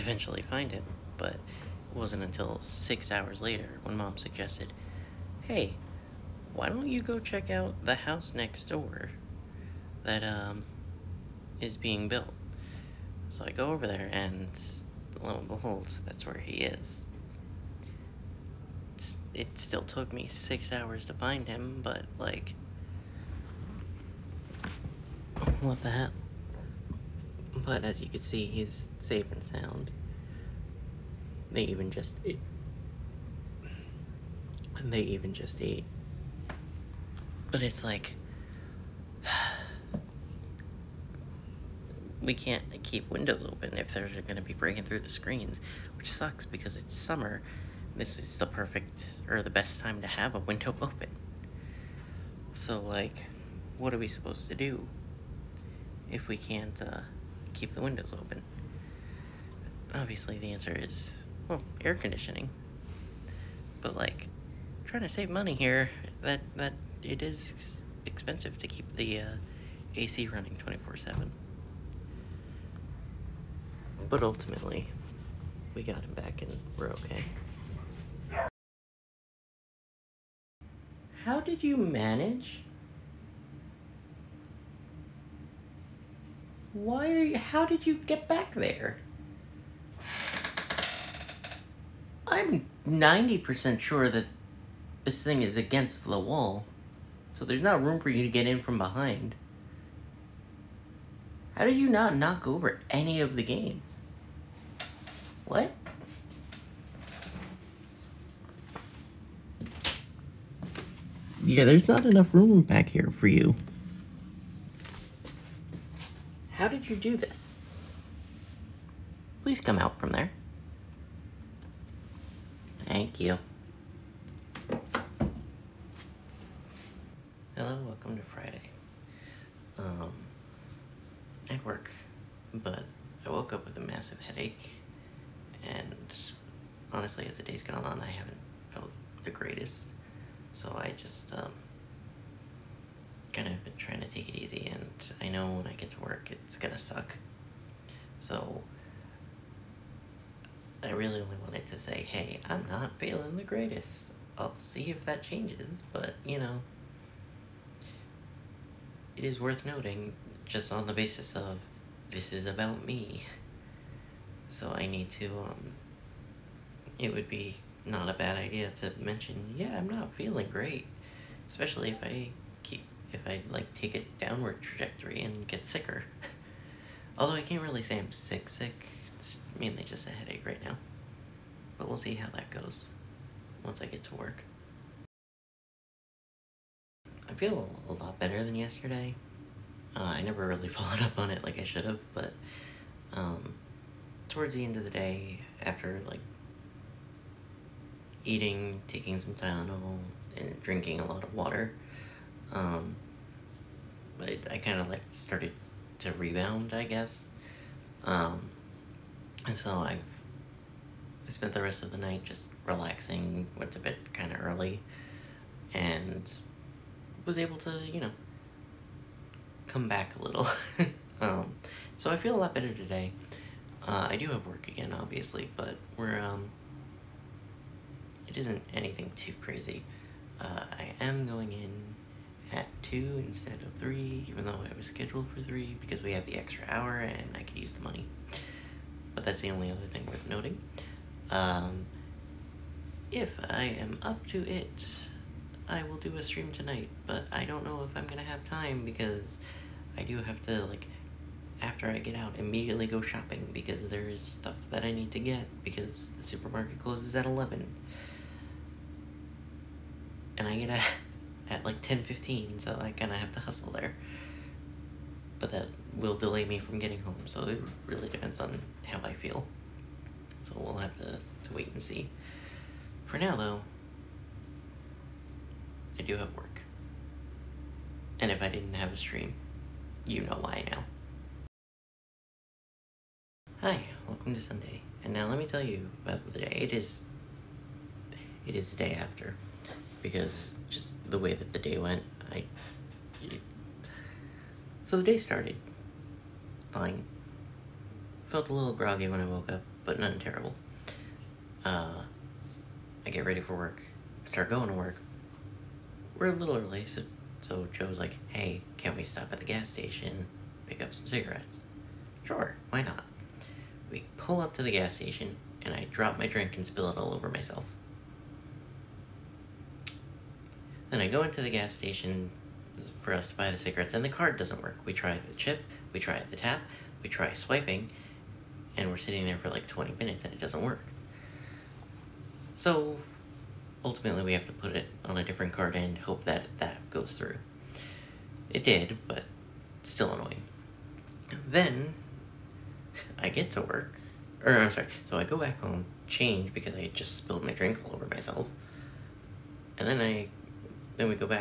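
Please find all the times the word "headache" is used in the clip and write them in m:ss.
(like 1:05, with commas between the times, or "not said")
2:14, 3:00.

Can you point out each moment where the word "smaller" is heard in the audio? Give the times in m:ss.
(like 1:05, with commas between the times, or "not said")
not said.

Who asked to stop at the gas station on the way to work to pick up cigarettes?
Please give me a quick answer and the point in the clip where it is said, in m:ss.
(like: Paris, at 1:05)
Joe, at 5:07.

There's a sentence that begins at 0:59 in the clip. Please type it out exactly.
Obviously the answer is, well, air conditioning.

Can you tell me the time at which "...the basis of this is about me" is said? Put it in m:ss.
2:40.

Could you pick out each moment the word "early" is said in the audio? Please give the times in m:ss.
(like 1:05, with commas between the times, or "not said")
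3:34, 5:06.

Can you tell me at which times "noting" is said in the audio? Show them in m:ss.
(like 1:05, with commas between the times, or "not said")
2:39, 4:00.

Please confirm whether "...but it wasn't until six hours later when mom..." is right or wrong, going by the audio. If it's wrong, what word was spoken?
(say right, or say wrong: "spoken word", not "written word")
right.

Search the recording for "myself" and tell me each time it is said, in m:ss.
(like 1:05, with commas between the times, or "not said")
5:17, 5:48.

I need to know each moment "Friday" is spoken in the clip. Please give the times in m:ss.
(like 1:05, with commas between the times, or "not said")
2:08.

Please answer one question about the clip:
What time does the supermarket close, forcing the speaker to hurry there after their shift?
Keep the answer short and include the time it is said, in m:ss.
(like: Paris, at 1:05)
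11, at 4:17.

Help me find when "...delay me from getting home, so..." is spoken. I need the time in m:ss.
4:26.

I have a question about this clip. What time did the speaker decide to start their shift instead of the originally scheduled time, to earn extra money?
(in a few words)
2.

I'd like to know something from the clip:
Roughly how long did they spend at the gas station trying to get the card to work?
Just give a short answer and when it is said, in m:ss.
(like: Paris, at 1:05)
20 minutes, at 5:29.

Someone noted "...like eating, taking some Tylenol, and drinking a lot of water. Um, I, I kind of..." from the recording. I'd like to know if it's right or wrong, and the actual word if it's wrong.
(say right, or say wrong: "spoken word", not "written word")
right.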